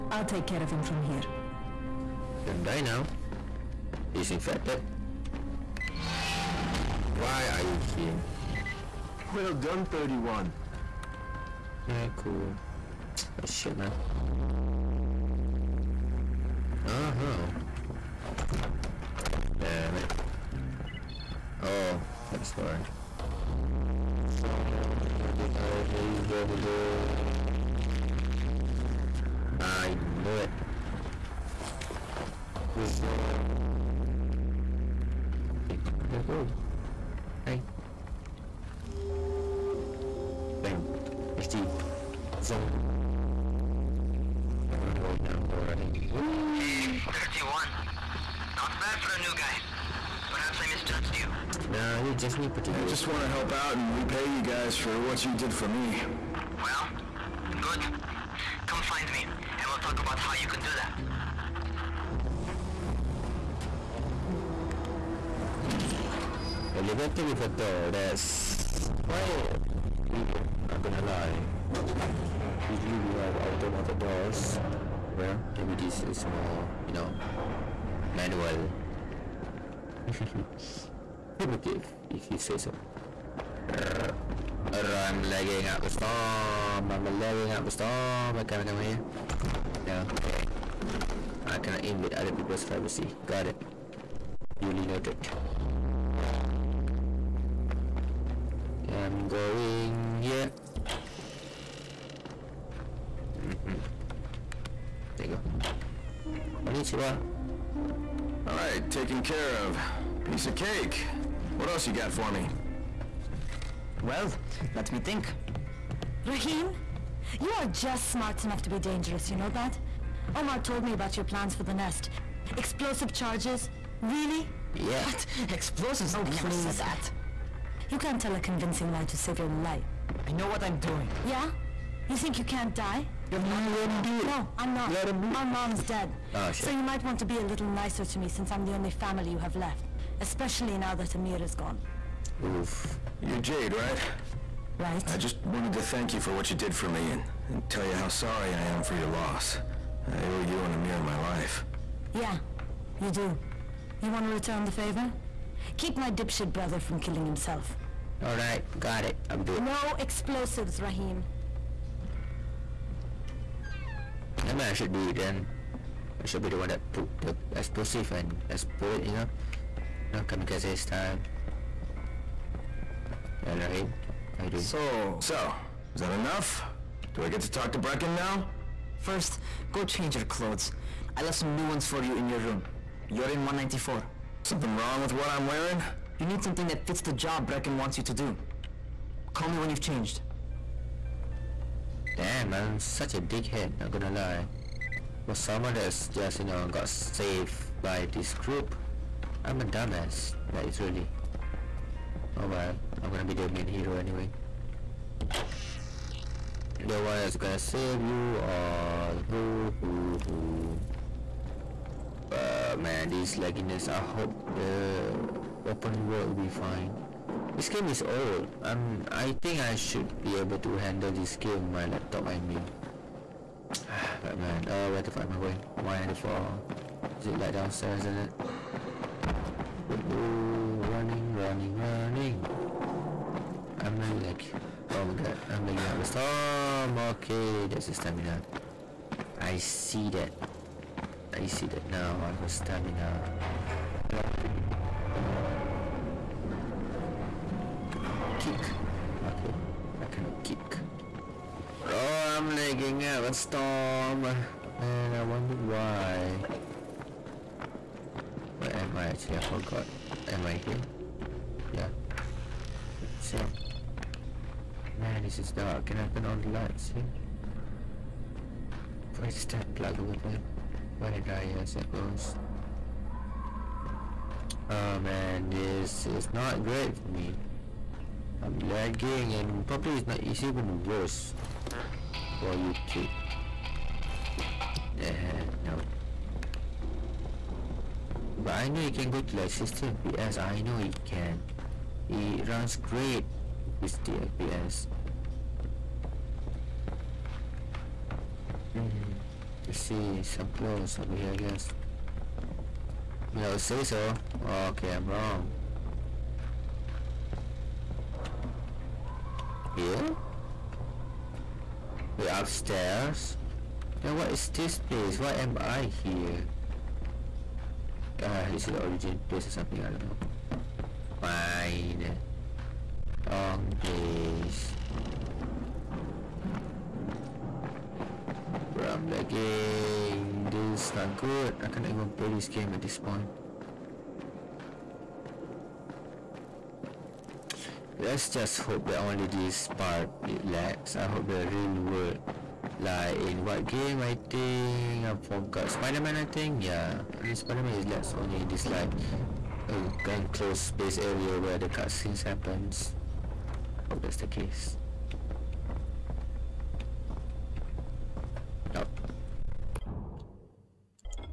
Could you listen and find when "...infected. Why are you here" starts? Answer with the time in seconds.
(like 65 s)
4 s.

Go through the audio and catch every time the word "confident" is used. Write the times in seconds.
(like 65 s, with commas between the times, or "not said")
not said.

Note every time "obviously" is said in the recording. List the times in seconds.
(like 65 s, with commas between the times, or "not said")
not said.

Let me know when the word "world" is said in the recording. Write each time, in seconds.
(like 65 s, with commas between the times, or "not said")
216 s, 341 s.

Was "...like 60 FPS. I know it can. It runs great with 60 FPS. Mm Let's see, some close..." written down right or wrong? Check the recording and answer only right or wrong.
right.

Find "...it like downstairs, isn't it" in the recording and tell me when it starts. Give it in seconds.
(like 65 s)
227 s.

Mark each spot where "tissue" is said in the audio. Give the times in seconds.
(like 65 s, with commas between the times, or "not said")
not said.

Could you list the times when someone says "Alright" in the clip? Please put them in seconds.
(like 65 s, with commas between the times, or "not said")
158 s, 173 s.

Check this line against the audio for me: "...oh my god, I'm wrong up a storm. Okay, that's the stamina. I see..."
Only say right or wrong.
wrong.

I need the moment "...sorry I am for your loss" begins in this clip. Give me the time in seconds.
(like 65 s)
148 s.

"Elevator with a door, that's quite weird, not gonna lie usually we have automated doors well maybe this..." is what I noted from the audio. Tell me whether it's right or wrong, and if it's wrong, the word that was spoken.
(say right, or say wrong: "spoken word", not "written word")
right.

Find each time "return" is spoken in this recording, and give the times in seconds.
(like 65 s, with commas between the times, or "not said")
154 s.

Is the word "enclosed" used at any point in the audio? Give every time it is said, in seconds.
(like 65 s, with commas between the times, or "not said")
350 s.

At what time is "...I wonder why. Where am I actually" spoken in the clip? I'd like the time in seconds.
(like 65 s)
255 s.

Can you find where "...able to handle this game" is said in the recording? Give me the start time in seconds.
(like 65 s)
220 s.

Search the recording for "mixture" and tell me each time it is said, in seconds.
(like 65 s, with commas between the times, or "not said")
not said.